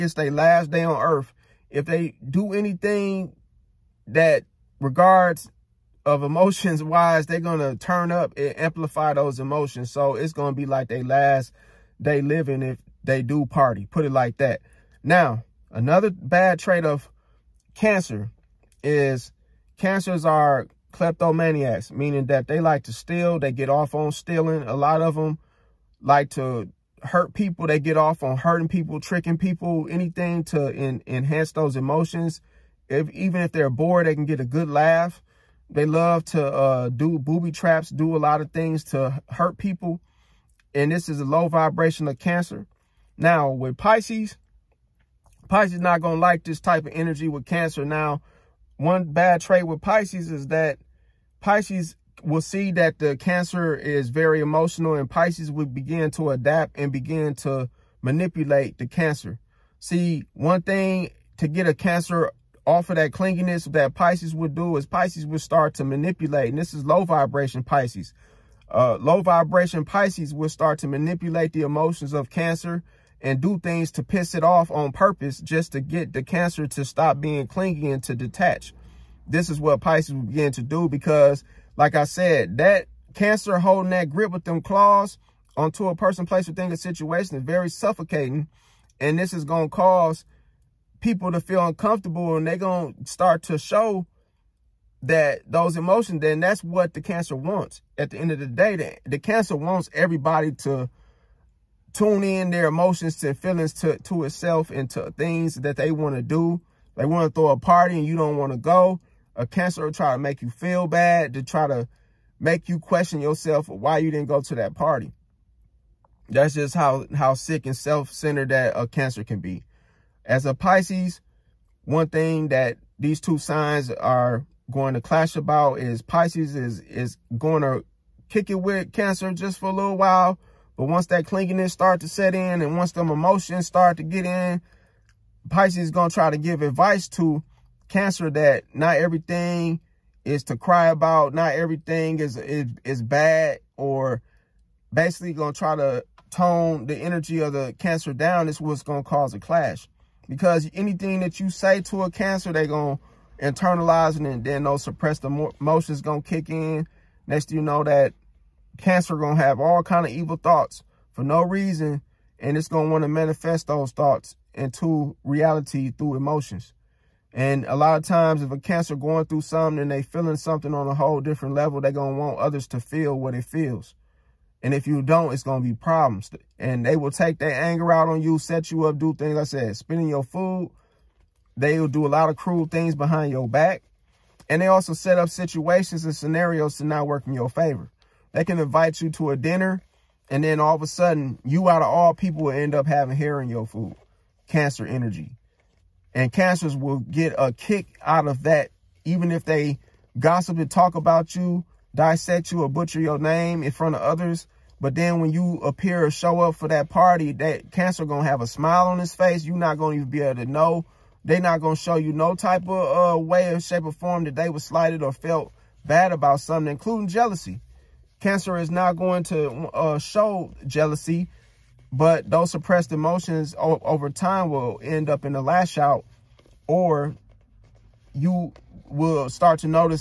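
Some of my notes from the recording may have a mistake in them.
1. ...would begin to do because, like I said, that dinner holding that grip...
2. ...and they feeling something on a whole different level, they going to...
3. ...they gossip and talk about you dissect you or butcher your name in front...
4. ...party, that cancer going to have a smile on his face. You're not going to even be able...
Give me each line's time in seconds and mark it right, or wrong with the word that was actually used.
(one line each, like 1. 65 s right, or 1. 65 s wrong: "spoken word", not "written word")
1. 80 s wrong: "cancer", not "dinner"
2. 169 s right
3. 199 s right
4. 206 s right.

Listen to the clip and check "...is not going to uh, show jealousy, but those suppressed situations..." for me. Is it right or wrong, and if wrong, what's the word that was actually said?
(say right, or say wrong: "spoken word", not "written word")
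wrong: "emotions", not "situations".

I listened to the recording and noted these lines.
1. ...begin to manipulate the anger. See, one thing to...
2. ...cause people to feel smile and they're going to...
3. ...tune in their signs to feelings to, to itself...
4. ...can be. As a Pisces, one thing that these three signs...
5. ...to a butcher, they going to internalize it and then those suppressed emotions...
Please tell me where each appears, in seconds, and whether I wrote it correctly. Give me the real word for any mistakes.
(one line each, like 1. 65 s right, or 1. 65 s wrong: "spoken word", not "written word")
1. 56 s wrong: "cancer", not "anger"
2. 89 s wrong: "uncomfortable", not "smile"
3. 101 s wrong: "emotions", not "signs"
4. 119 s wrong: "two", not "three"
5. 151 s wrong: "cancer", not "butcher".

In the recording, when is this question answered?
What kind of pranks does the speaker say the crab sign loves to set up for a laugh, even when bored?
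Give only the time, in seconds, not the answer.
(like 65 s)
37 s.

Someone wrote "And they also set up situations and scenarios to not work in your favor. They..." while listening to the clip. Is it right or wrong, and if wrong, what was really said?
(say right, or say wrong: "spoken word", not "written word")
right.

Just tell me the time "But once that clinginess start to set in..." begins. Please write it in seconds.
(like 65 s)
130 s.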